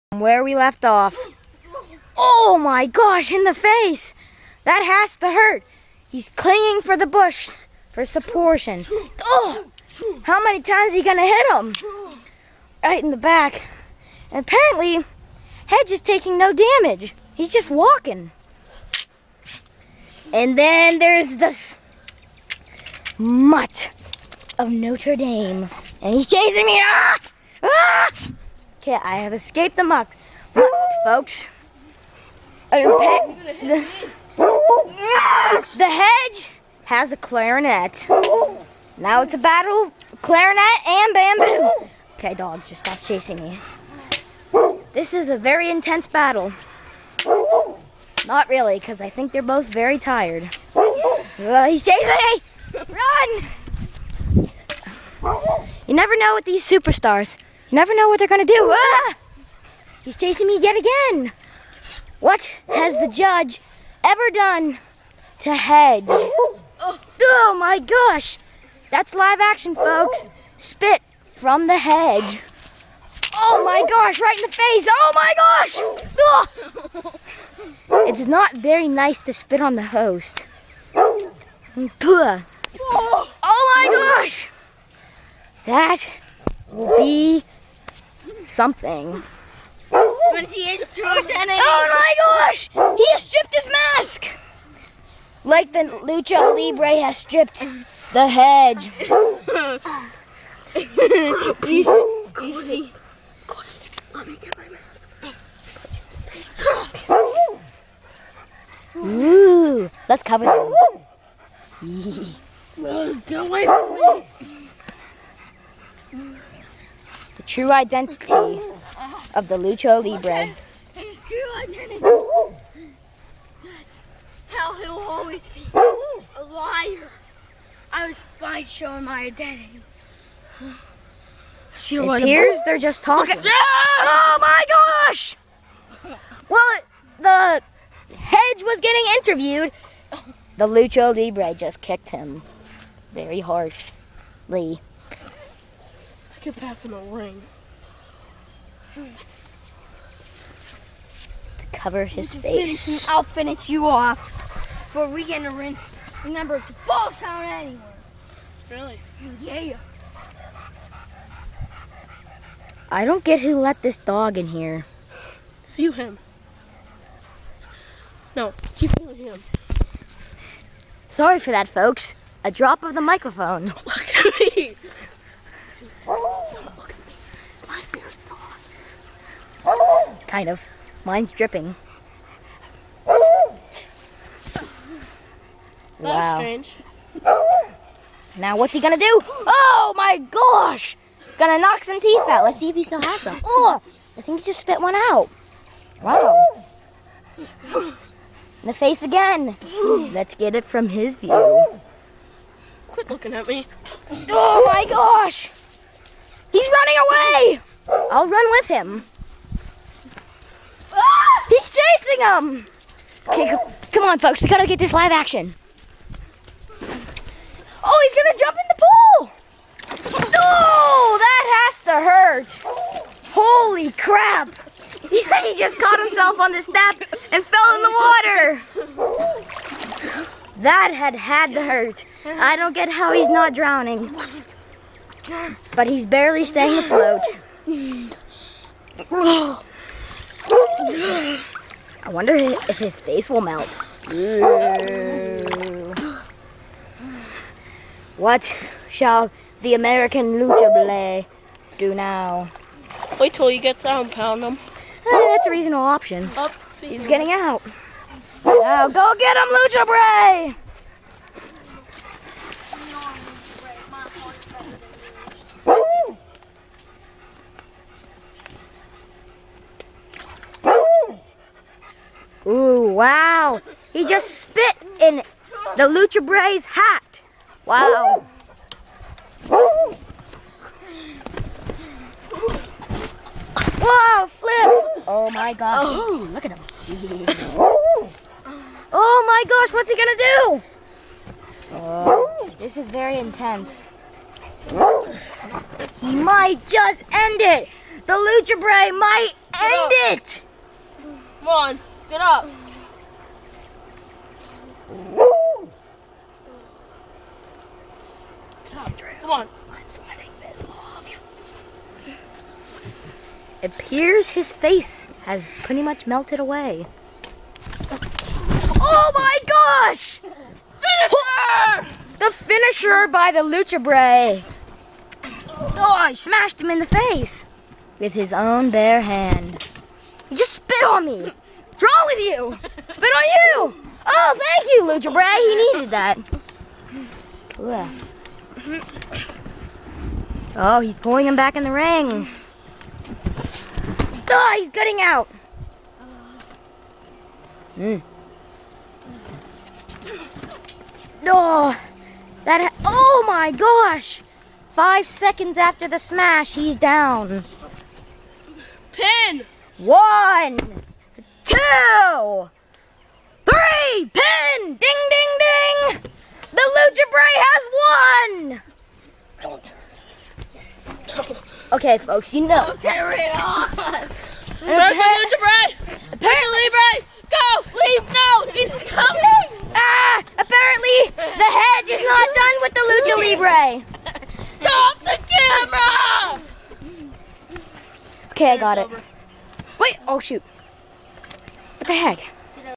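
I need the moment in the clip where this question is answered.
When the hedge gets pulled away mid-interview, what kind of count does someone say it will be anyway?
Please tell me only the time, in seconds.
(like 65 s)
156 s.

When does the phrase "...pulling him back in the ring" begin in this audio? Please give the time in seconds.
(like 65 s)
340 s.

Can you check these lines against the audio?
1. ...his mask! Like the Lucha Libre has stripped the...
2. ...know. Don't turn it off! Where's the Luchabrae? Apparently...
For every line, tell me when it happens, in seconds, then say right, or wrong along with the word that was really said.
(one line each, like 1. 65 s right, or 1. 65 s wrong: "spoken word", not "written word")
1. 93 s right
2. 372 s right.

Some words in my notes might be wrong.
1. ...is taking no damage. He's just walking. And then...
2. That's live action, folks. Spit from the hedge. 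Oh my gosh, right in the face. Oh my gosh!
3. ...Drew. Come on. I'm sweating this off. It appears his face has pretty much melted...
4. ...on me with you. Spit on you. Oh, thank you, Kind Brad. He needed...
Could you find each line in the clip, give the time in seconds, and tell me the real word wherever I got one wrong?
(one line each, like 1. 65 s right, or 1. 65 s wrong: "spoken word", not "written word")
1. 15 s right
2. 68 s right
3. 308 s right
4. 330 s wrong: "Lucha", not "Kind".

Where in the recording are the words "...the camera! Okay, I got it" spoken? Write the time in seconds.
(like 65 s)
384 s.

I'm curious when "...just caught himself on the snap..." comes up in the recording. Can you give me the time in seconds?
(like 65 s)
225 s.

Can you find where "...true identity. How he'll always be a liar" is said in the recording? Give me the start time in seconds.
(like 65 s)
121 s.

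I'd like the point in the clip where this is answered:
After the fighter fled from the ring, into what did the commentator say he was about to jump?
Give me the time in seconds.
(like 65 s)
220 s.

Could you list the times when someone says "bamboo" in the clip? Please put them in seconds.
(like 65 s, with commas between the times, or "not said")
41 s.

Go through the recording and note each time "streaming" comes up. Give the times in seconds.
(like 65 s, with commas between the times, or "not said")
not said.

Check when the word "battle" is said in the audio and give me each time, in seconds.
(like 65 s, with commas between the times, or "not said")
39 s, 46 s.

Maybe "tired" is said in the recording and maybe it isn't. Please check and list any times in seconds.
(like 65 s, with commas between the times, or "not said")
49 s.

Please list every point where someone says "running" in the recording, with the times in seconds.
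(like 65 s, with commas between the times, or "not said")
206 s.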